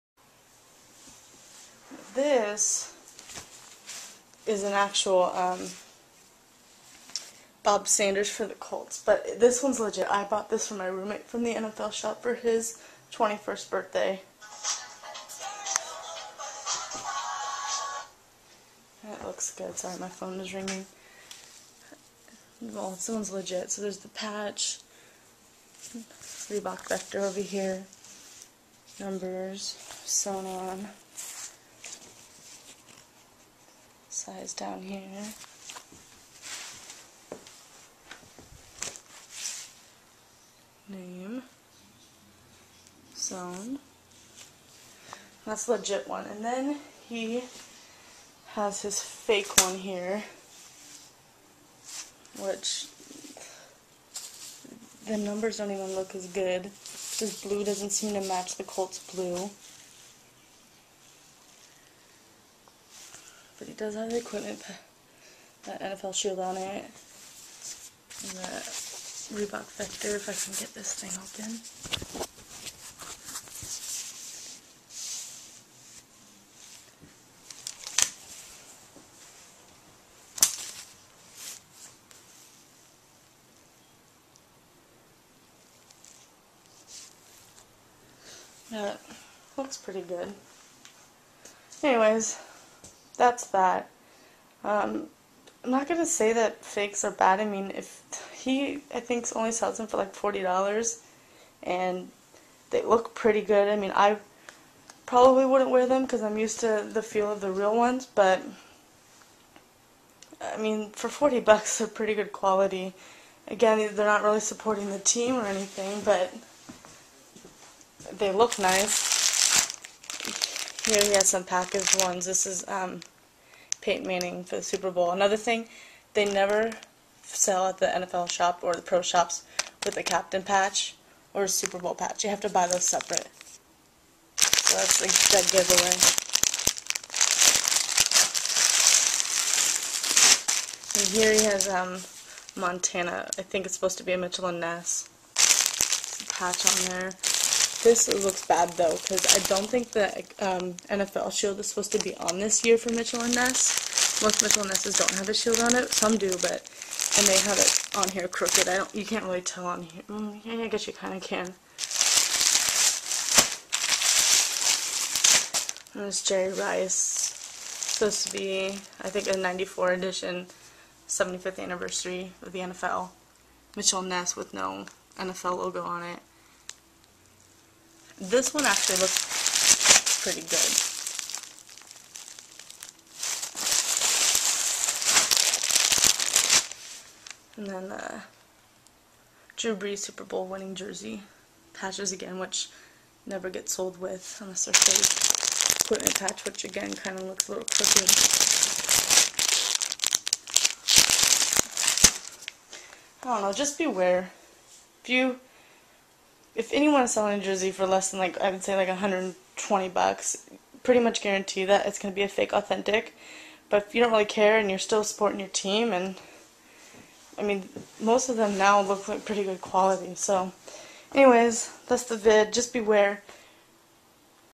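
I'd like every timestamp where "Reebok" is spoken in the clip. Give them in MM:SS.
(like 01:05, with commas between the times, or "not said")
00:25, 01:09.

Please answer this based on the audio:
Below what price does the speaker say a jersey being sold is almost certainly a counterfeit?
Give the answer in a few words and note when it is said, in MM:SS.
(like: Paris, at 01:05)
$120, at 03:28.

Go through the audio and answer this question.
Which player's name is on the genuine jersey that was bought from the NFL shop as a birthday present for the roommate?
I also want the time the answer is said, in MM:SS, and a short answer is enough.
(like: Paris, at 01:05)
Bob Sanders, at 00:07.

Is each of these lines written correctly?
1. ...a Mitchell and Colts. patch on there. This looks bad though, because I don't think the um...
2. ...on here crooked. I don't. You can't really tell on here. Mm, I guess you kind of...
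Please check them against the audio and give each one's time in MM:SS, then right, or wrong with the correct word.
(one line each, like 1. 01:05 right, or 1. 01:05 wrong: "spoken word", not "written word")
1. 02:24 wrong: "Ness", not "Colts"
2. 02:37 right.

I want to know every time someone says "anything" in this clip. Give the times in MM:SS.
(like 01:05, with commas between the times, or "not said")
01:55.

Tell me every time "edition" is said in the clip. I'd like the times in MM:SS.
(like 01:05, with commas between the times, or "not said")
02:49.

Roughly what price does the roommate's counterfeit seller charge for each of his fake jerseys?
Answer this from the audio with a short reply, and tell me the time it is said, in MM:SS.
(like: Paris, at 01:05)
$40, at 01:40.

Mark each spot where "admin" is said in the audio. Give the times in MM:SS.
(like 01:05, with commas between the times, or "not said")
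not said.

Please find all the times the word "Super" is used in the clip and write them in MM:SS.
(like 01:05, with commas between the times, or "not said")
02:04, 02:11, 03:09.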